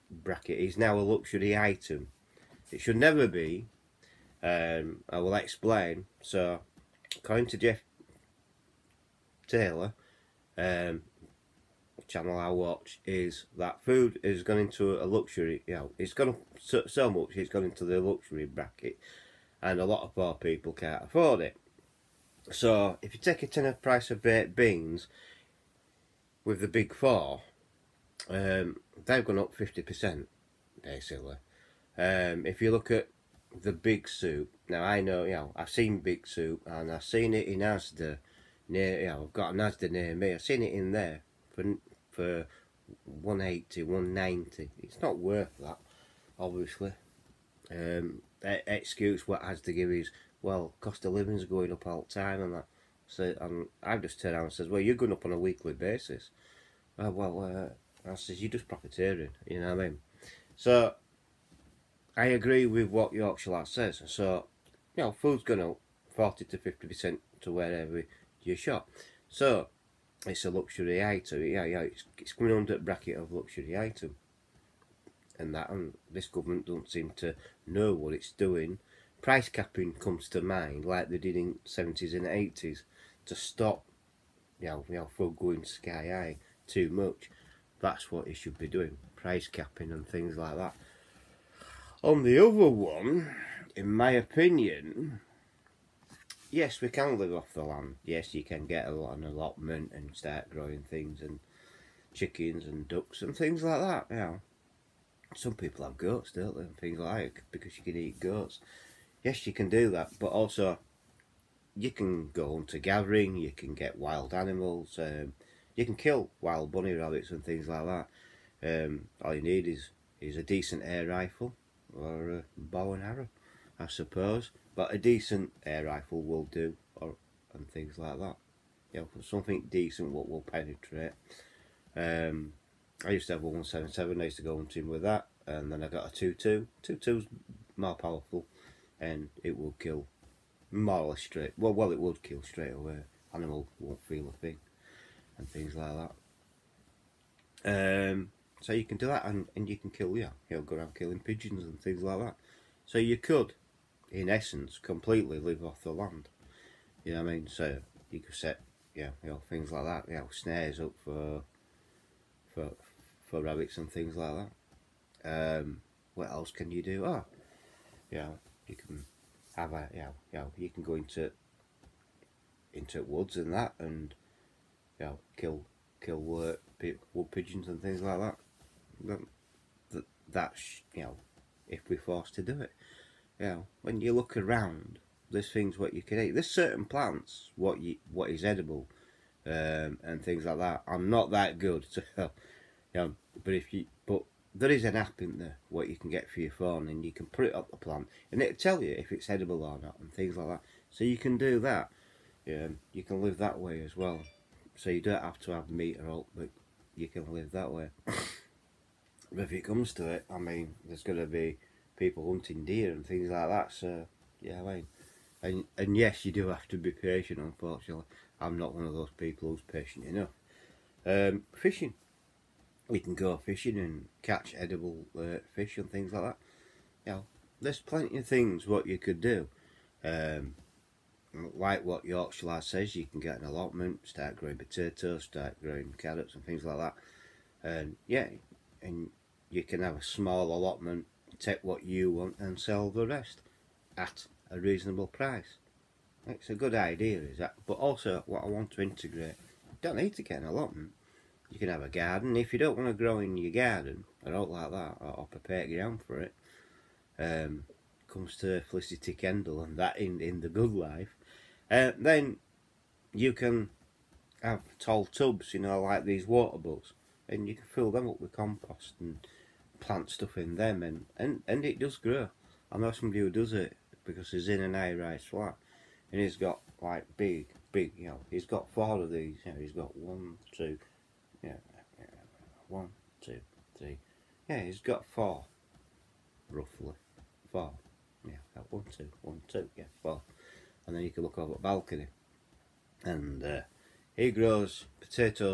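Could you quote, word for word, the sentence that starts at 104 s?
You know, some people have goats, don't they?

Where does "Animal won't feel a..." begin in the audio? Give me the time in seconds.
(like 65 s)
143 s.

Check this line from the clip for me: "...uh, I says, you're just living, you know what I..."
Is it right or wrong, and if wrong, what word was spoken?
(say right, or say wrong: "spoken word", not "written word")
wrong: "profiteering", not "living".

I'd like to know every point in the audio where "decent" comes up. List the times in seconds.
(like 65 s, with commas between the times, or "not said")
120 s, 124 s, 129 s.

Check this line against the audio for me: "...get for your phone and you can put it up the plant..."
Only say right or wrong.
right.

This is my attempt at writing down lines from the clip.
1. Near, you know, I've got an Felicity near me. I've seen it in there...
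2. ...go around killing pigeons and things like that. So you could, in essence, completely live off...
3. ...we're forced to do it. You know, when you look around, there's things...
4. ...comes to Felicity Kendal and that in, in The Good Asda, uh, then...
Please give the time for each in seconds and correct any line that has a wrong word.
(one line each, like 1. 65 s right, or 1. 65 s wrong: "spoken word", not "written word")
1. 38 s wrong: "Asda", not "Felicity"
2. 150 s right
3. 181 s right
4. 258 s wrong: "Life", not "Asda".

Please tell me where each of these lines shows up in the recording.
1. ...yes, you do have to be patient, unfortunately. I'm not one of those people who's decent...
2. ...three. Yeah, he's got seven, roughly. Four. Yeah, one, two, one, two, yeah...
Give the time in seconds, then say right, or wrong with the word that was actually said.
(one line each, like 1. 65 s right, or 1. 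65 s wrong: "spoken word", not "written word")
1. 215 s wrong: "patient", not "decent"
2. 283 s wrong: "four", not "seven".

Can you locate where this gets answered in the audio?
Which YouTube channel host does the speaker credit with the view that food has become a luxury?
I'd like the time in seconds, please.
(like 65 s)
7 s.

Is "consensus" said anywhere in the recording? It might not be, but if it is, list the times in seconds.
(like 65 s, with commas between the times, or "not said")
not said.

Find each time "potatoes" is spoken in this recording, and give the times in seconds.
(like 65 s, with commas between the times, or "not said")
234 s, 294 s.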